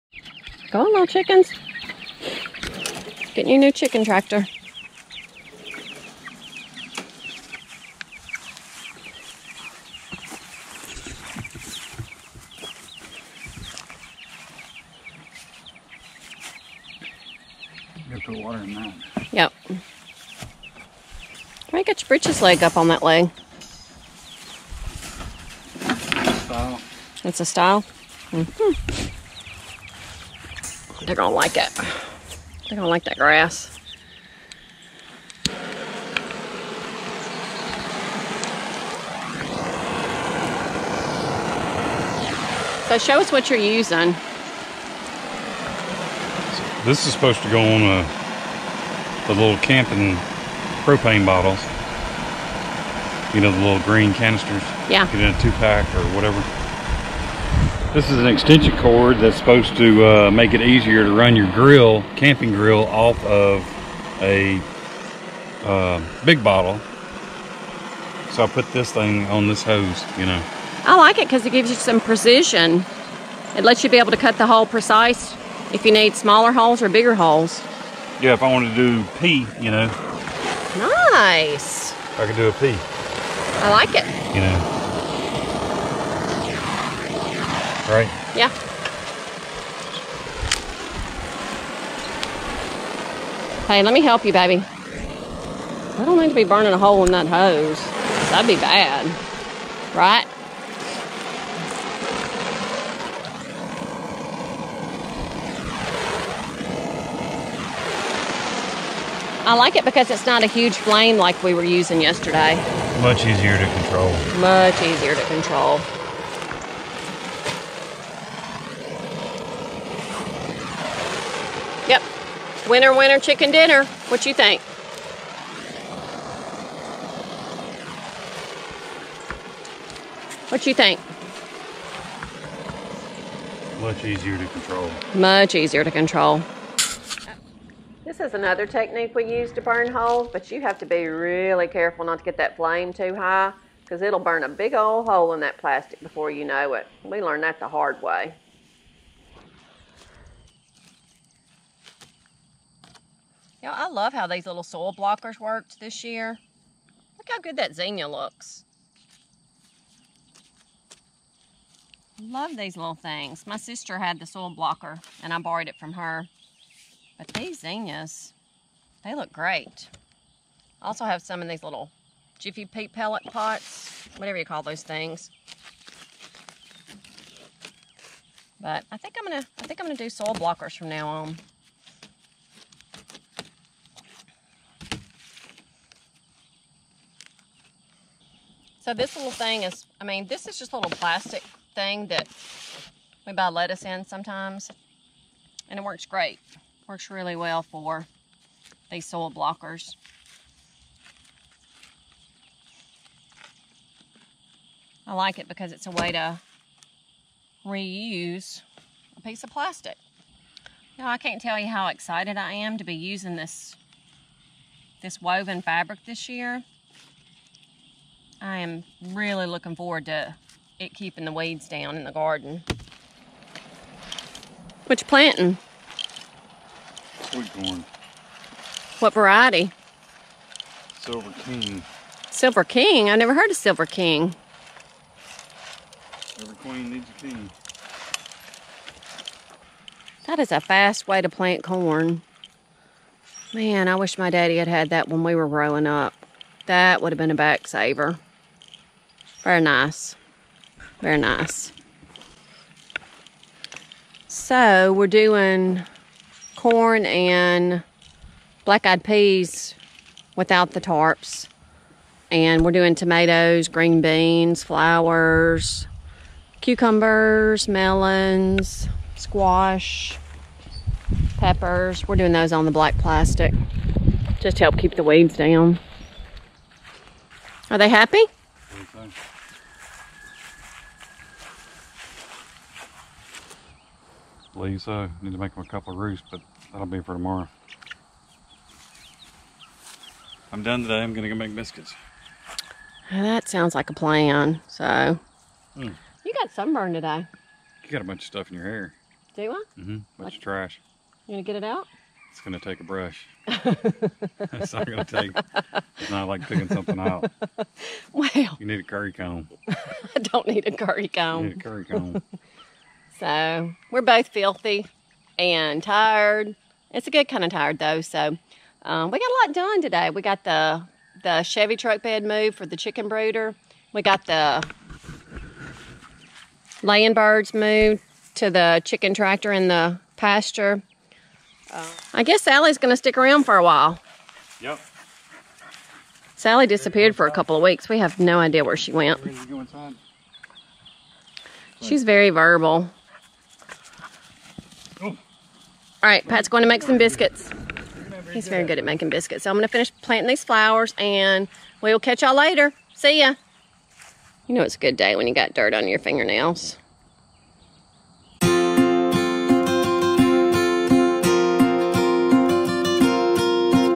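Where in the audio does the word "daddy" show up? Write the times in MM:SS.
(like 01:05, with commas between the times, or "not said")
04:04.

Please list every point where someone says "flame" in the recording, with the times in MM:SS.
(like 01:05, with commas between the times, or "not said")
01:50, 02:22.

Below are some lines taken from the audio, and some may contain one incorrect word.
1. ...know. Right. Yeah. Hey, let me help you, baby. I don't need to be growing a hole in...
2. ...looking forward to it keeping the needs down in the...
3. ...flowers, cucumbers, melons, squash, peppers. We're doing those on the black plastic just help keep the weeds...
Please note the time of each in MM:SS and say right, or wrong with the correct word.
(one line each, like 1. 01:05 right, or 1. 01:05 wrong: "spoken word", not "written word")
1. 01:24 wrong: "burning", not "growing"
2. 03:39 wrong: "weeds", not "needs"
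3. 04:24 right.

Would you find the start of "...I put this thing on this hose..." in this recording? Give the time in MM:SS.
01:08.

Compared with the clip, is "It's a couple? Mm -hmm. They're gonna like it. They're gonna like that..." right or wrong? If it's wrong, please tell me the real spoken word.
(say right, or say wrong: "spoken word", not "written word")
wrong: "style", not "couple".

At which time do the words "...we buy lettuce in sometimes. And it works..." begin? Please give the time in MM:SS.
03:13.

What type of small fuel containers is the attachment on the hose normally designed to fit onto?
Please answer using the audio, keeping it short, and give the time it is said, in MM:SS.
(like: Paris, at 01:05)
Camping propane bottles, at 00:49.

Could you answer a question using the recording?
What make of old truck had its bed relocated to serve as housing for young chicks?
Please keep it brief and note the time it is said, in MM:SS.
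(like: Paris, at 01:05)
Chevy, at 05:21.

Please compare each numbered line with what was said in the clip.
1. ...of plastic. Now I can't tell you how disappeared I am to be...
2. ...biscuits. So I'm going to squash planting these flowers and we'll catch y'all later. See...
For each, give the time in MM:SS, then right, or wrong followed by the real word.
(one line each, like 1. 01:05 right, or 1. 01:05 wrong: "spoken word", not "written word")
1. 03:29 wrong: "excited", not "disappeared"
2. 05:49 wrong: "finish", not "squash".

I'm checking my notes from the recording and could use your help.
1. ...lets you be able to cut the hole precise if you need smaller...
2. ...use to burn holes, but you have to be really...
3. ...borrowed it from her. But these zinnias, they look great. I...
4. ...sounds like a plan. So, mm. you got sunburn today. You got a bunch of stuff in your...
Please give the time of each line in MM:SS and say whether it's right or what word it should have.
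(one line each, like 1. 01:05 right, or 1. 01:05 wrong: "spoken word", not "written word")
1. 01:13 right
2. 02:19 right
3. 02:45 right
4. 04:53 right.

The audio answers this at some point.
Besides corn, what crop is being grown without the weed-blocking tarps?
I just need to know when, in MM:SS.
04:18.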